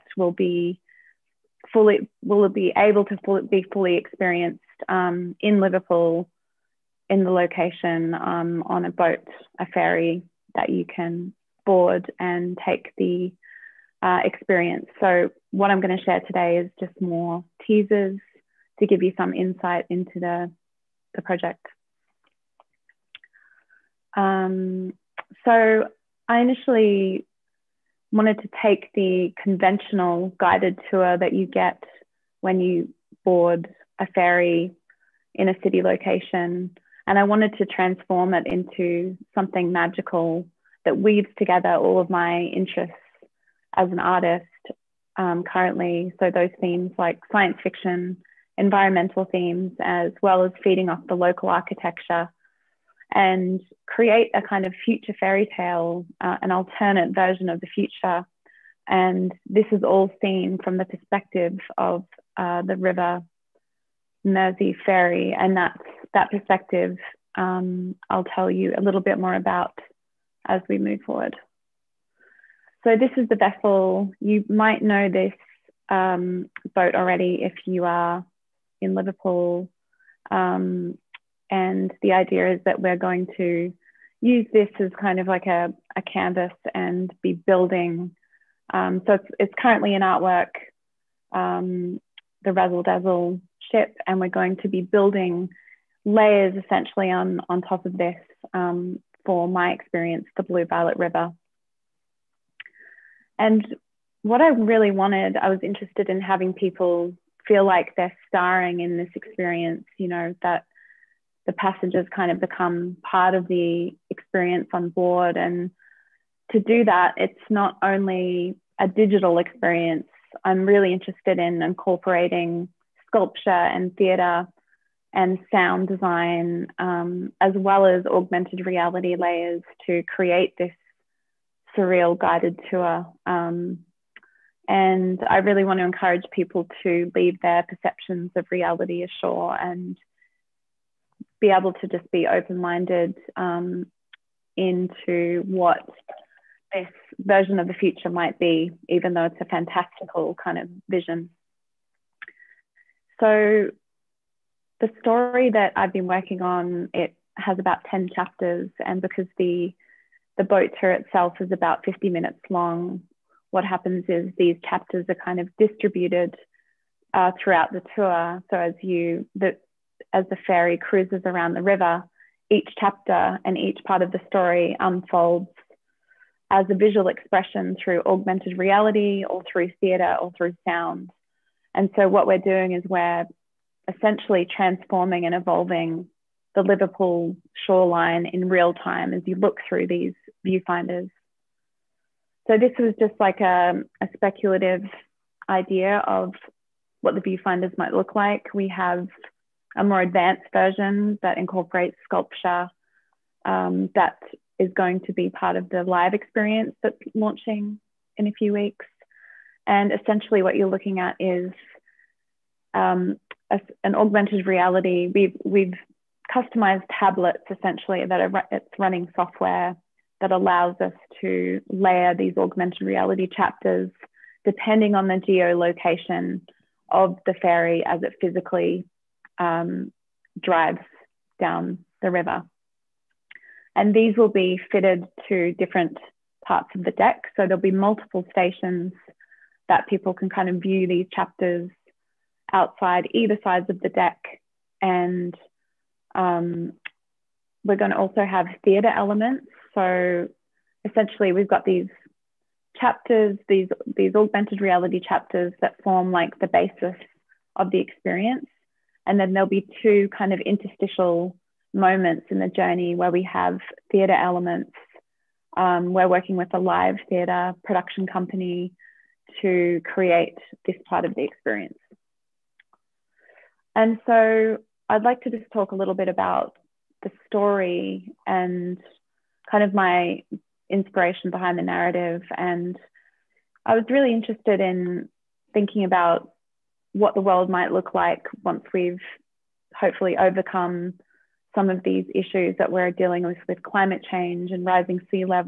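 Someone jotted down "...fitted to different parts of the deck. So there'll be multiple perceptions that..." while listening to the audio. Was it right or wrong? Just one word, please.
wrong.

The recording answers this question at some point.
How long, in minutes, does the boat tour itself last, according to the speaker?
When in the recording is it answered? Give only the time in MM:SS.
02:41.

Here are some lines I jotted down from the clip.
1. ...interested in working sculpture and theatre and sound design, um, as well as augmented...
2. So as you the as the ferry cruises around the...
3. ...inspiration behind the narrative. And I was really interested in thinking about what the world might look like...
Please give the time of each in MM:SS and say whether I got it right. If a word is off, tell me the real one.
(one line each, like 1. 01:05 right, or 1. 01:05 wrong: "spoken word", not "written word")
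1. 02:00 wrong: "incorporating", not "working"
2. 02:48 right
3. 04:40 right.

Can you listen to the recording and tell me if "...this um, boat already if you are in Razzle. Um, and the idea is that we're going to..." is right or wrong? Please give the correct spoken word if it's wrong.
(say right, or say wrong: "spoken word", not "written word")
wrong: "Liverpool", not "Razzle".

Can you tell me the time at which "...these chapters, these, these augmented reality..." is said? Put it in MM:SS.
04:11.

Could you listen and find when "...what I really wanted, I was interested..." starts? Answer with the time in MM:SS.
01:44.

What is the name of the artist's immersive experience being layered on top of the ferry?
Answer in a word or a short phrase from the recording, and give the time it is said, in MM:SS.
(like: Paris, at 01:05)
Blue Violet River, at 01:40.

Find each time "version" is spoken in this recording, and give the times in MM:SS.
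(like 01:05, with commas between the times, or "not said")
00:57, 02:27, 03:20.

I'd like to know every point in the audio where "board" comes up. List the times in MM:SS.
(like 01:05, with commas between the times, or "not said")
00:11, 00:33, 01:54.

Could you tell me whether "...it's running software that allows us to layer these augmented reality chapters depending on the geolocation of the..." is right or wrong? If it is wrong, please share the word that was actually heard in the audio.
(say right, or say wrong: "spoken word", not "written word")
right.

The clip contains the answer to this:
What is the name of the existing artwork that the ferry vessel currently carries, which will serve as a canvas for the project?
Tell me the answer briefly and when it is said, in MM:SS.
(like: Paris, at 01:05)
Razzle Dazzle ship, at 01:32.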